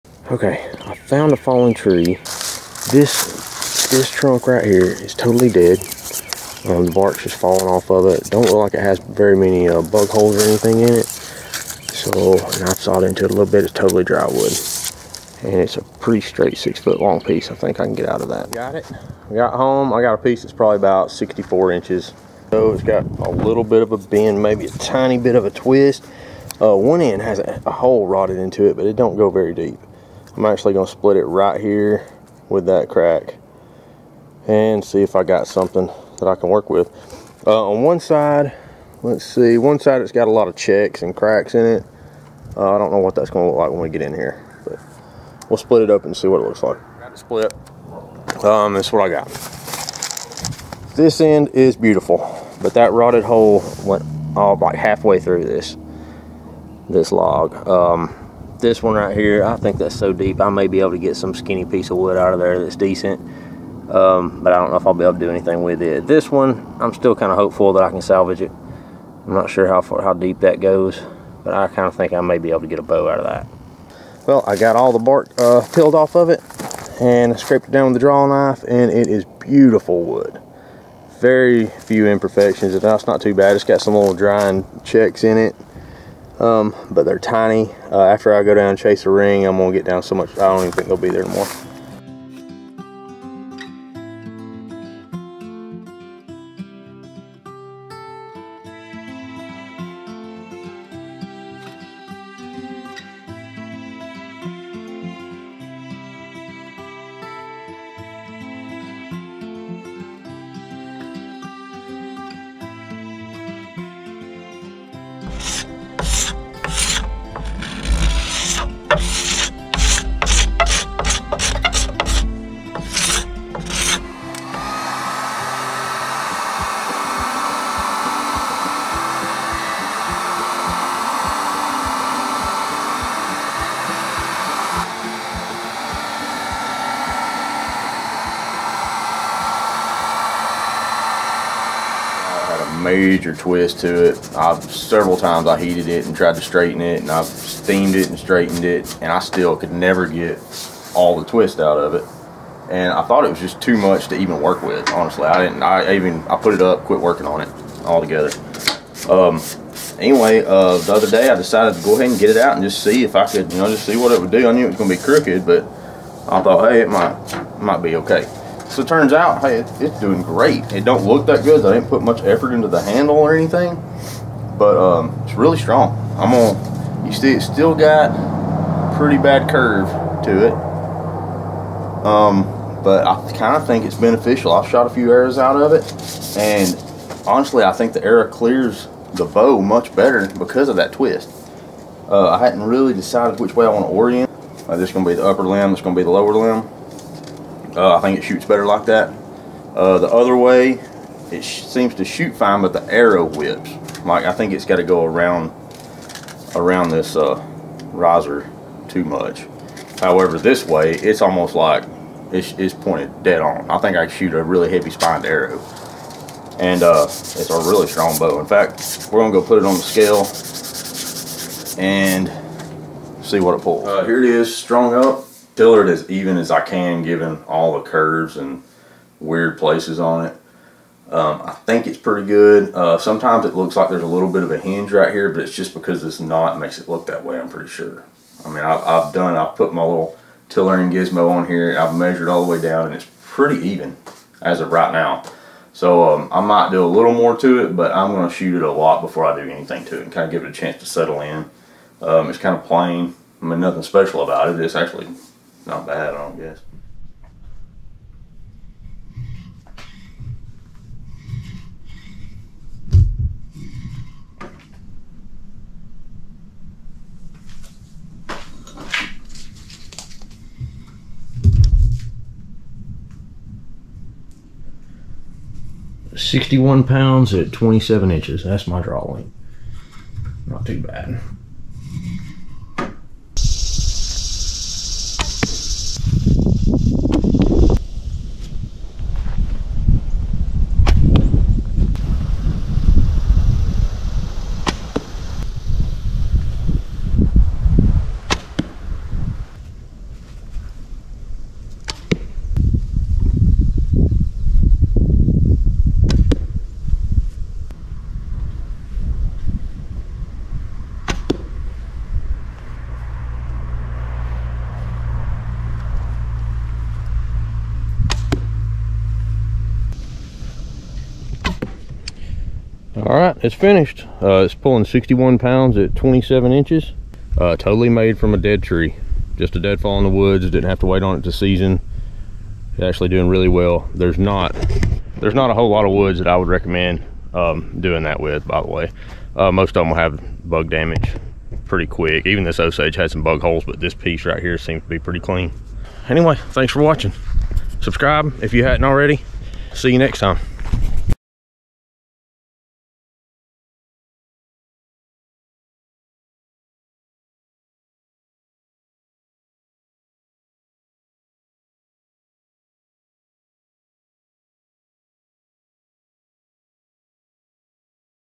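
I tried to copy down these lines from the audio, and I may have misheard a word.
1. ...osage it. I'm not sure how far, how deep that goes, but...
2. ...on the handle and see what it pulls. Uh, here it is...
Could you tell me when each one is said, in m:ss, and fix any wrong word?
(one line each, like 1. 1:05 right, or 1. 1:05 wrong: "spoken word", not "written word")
1. 1:08 wrong: "salvage", not "osage"
2. 3:39 wrong: "scale", not "handle".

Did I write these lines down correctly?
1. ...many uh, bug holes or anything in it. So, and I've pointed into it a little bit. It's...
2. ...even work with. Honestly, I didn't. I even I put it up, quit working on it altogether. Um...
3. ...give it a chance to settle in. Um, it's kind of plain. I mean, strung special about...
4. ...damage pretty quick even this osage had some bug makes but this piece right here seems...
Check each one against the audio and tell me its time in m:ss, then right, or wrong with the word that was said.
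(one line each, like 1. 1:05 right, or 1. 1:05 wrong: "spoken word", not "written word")
1. 0:09 wrong: "sawed", not "pointed"
2. 2:34 right
3. 4:10 wrong: "nothing", not "strung"
4. 5:40 wrong: "holes", not "makes".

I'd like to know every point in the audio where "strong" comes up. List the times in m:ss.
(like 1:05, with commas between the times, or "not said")
2:55, 3:37.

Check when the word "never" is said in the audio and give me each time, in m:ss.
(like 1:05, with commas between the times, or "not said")
2:29.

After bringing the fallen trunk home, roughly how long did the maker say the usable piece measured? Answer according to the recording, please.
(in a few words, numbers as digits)
64 inches.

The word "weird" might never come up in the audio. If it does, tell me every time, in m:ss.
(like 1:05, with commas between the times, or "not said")
3:49.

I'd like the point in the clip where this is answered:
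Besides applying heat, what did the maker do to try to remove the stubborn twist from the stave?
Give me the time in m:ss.
2:27.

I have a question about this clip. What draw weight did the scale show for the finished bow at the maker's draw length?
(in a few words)
61 pounds.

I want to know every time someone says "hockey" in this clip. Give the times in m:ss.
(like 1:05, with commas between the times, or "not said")
not said.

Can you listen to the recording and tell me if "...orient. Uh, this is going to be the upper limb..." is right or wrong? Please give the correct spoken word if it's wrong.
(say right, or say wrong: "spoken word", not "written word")
right.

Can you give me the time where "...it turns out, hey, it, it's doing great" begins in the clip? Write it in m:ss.
2:48.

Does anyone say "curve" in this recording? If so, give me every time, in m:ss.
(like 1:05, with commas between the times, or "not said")
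2:59, 3:47.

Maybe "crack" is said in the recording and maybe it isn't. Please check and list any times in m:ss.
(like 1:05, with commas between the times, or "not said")
0:32, 0:41.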